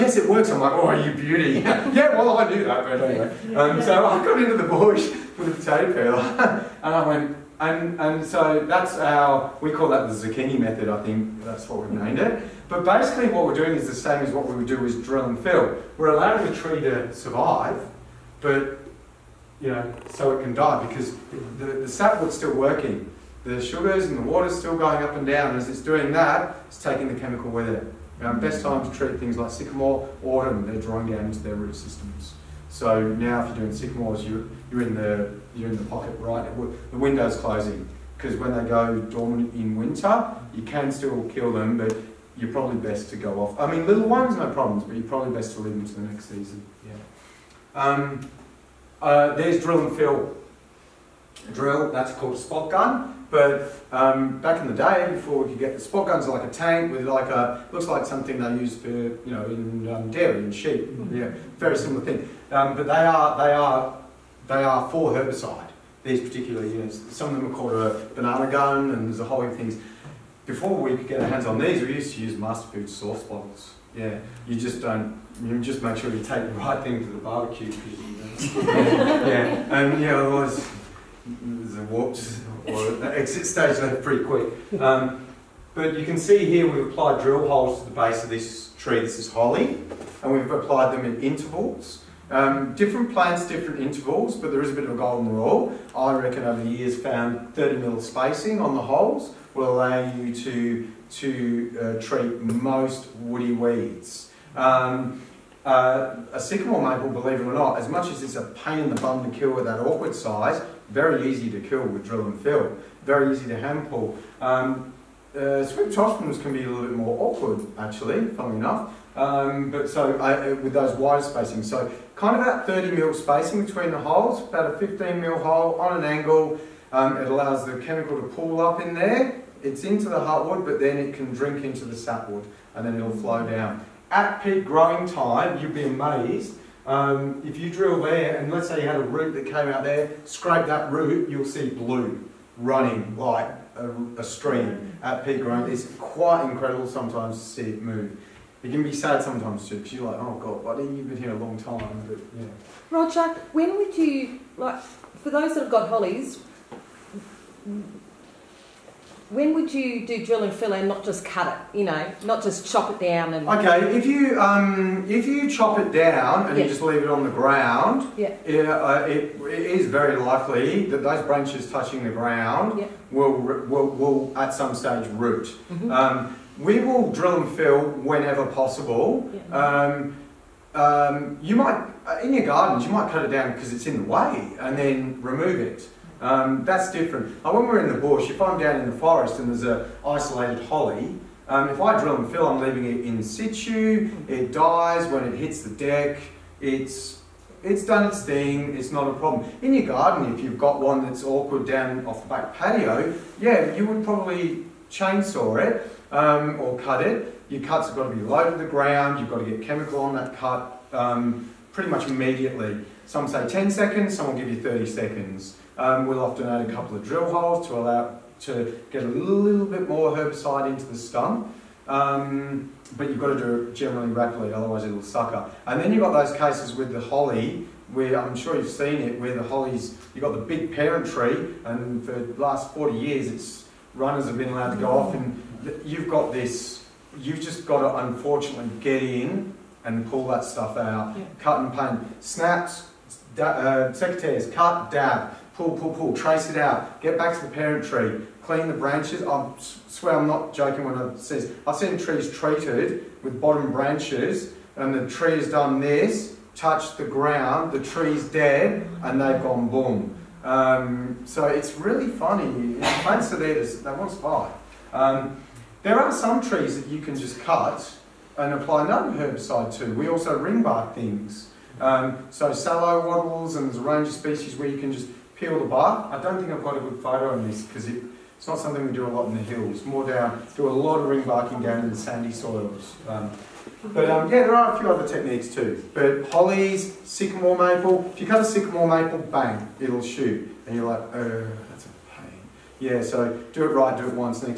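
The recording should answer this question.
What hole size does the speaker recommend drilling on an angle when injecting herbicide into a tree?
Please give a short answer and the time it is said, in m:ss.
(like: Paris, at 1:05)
15 mm, at 2:04.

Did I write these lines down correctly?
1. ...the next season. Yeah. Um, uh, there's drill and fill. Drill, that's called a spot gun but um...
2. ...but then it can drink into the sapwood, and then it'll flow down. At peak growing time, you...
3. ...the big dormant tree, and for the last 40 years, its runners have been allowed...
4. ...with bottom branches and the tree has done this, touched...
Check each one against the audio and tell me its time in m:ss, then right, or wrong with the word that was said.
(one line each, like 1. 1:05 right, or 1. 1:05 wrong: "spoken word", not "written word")
1. 0:45 right
2. 2:10 right
3. 3:50 wrong: "parent", not "dormant"
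4. 4:13 right.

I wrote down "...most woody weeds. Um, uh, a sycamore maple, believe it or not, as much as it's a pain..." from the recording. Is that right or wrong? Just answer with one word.
right.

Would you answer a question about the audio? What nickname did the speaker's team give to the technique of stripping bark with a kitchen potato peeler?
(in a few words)
the zucchini method.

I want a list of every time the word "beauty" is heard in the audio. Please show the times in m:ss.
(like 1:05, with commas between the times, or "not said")
0:01.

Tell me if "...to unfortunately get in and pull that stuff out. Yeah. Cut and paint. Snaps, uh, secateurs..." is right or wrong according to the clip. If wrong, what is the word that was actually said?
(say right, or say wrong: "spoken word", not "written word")
right.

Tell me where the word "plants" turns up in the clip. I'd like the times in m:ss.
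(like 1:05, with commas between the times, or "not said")
1:33, 4:23.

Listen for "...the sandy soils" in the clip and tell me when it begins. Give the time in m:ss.
4:41.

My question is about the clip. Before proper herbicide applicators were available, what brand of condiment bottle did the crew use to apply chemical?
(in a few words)
MasterFoods.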